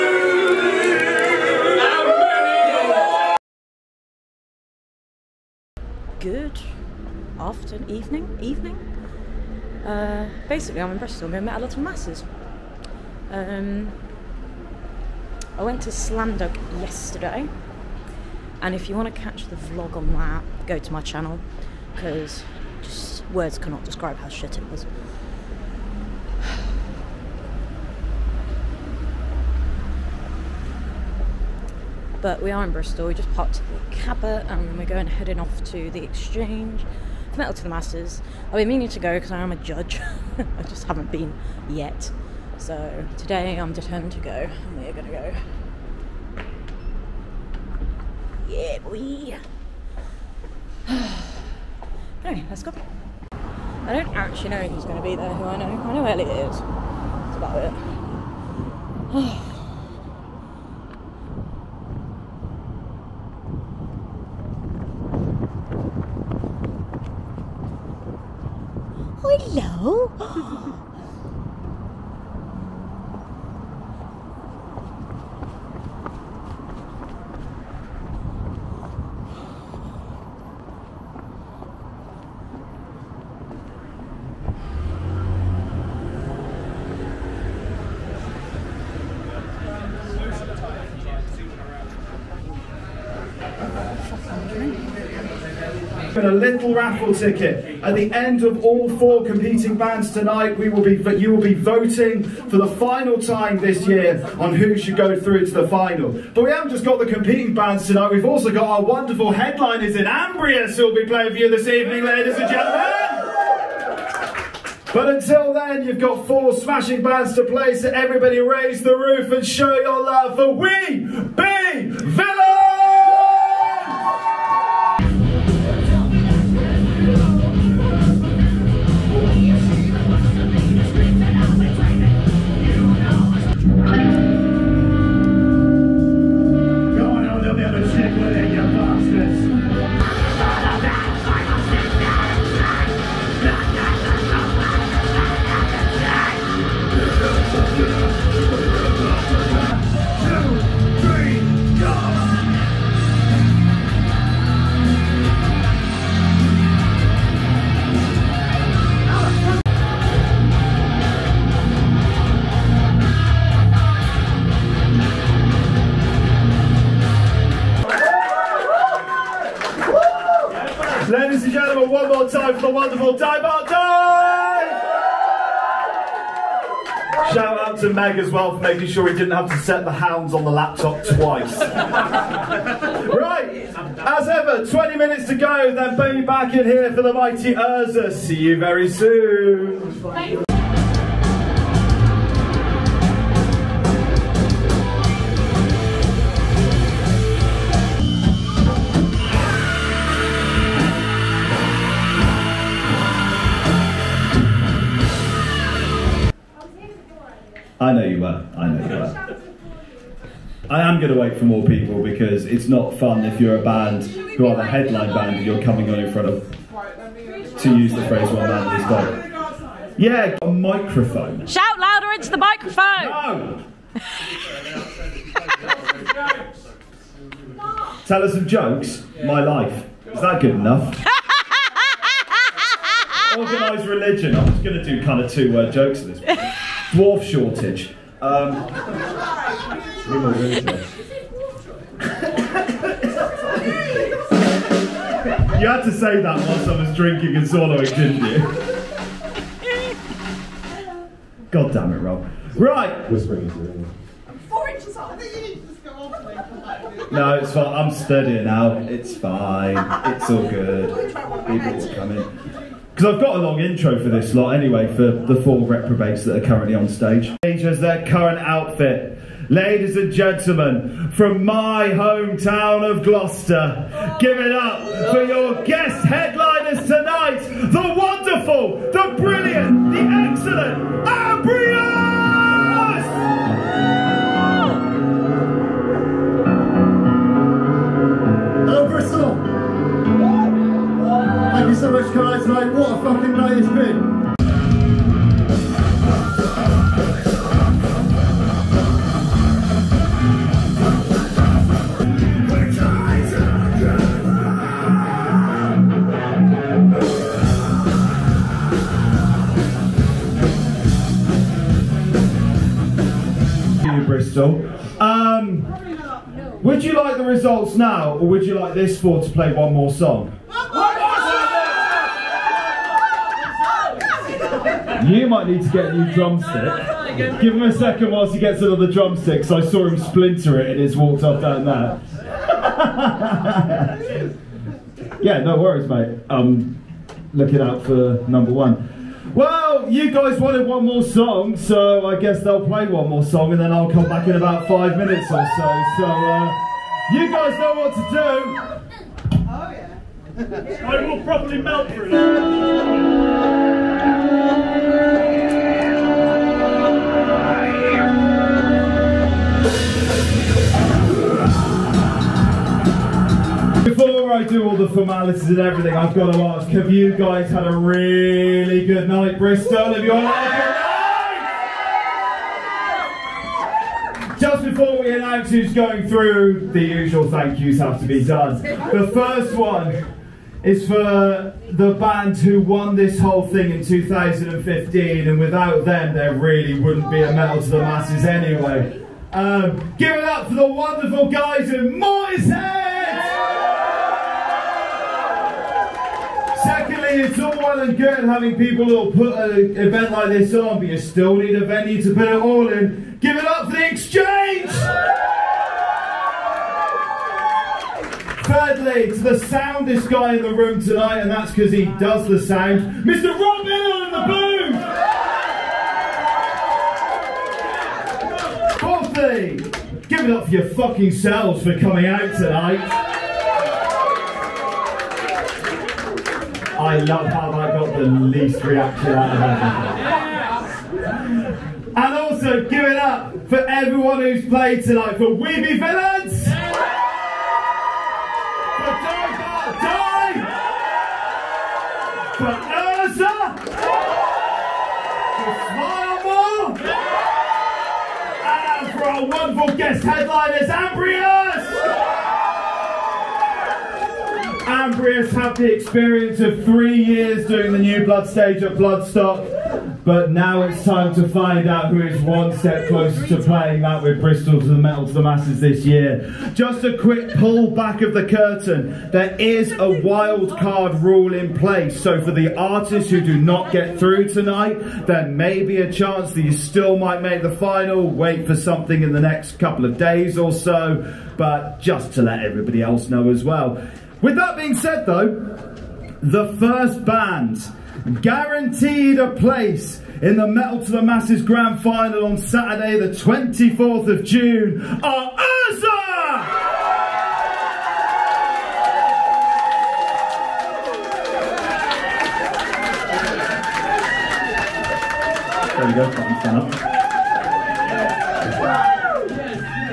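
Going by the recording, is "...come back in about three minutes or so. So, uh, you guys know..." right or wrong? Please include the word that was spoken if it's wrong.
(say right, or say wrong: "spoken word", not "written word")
wrong: "five", not "three".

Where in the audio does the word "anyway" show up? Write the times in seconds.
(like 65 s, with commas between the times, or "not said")
52 s, 264 s, 388 s.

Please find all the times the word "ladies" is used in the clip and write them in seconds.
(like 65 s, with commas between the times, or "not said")
112 s, 269 s.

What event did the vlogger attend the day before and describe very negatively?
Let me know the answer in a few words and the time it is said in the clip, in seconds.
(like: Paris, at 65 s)
Slam Dunk, at 15 s.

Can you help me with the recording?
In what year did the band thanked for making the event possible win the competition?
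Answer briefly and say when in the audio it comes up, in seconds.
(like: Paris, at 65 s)
2015, at 383 s.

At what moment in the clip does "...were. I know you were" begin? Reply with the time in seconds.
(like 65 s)
208 s.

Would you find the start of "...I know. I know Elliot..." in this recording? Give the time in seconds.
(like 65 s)
55 s.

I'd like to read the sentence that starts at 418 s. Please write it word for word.
Fourthly, give it up for your fucking selves for coming out tonight.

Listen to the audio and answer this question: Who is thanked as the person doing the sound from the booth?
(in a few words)
Rob Hill.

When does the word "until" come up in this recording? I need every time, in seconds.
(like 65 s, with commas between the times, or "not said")
115 s.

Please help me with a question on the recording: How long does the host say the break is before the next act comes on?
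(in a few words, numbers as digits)
20 minutes.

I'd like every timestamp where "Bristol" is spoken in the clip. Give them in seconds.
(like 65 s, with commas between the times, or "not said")
10 s, 32 s, 314 s, 369 s, 464 s.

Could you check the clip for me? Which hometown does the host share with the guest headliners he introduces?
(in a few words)
Gloucester.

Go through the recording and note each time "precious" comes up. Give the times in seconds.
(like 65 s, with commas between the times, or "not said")
not said.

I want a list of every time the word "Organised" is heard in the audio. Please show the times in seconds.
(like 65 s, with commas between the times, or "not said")
233 s.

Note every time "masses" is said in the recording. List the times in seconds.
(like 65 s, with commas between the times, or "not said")
11 s, 37 s, 387 s, 465 s, 491 s.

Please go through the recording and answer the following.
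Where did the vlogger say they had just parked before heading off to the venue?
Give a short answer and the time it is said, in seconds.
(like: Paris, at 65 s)
the Cabot, at 33 s.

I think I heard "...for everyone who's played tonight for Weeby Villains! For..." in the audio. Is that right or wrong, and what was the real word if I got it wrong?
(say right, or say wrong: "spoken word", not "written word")
right.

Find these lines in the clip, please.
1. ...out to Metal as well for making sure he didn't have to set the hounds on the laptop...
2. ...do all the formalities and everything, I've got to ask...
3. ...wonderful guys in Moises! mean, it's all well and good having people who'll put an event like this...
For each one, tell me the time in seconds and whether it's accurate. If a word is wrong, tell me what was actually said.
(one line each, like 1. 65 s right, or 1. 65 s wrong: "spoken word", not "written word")
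1. 177 s wrong: "Meg", not "Metal"
2. 364 s right
3. 390 s right.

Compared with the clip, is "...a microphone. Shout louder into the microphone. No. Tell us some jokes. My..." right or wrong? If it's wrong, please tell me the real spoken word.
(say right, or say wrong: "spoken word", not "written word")
right.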